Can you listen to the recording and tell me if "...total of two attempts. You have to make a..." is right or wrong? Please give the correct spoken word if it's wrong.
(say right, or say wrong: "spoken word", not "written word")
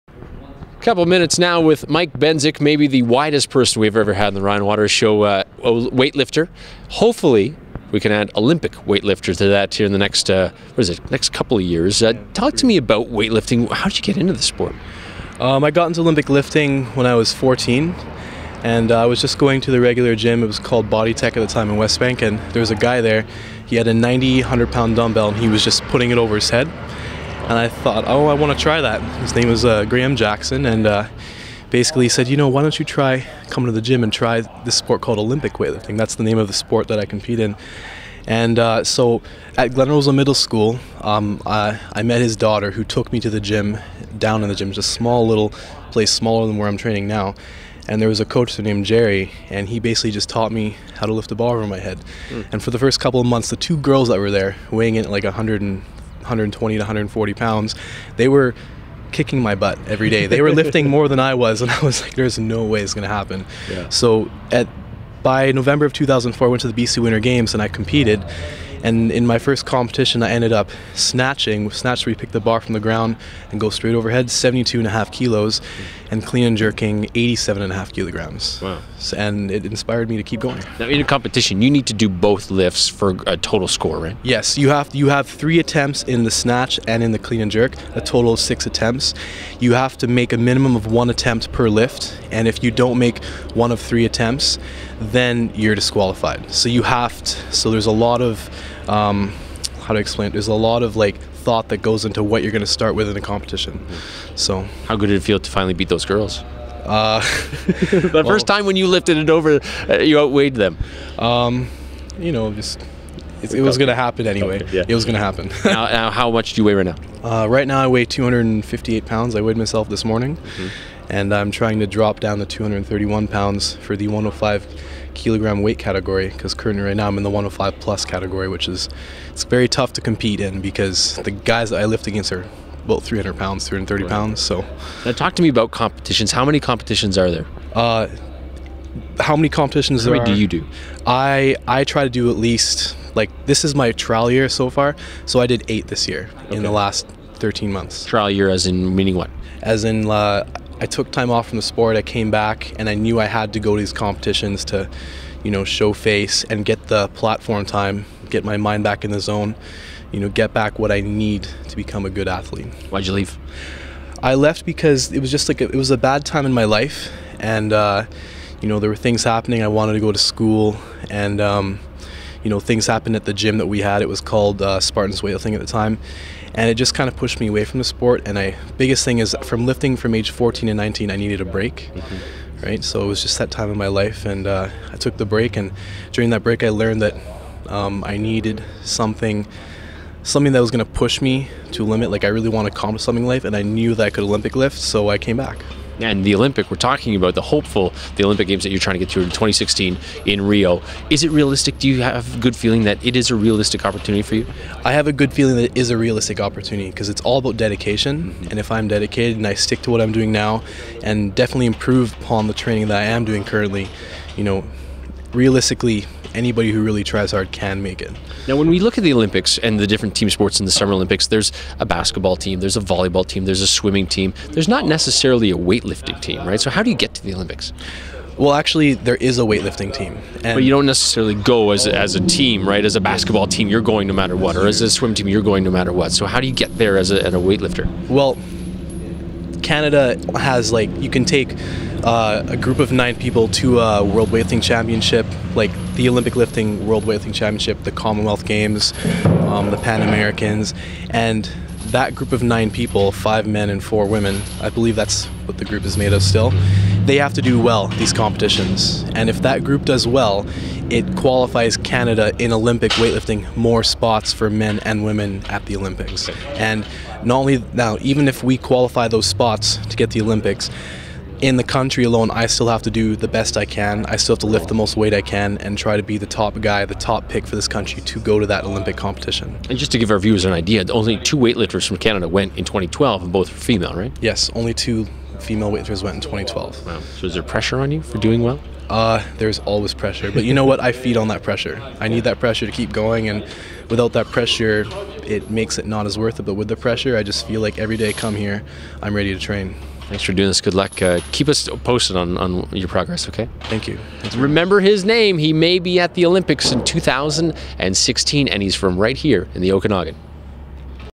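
wrong: "six", not "two".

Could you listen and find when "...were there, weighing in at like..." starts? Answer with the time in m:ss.
0:54.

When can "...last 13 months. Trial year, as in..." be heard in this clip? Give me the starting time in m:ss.
2:26.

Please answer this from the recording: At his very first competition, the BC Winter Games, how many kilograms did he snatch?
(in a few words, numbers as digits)
72.5 kilograms.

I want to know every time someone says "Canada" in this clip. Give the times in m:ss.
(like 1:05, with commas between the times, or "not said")
3:59, 4:21, 4:41.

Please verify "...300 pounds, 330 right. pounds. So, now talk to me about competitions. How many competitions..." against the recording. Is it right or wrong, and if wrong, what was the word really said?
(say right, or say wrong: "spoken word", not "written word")
right.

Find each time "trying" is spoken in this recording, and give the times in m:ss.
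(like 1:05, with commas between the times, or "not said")
2:01, 3:18.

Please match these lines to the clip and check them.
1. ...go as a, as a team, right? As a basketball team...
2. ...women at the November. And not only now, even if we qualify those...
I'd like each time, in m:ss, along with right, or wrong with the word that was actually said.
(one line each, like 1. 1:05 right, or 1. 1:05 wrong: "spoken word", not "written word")
1. 3:51 right
2. 4:25 wrong: "Olympics", not "November".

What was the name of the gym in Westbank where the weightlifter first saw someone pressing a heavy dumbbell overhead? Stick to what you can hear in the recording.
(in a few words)
Body Tech.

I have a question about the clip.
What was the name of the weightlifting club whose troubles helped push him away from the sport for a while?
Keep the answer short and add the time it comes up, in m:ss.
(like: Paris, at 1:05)
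Spartans Weightlifting, at 2:54.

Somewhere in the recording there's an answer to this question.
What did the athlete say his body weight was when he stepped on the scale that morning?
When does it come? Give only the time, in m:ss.
1:58.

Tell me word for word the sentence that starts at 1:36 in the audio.
So you have to, so there's a lot of um, how to explain it?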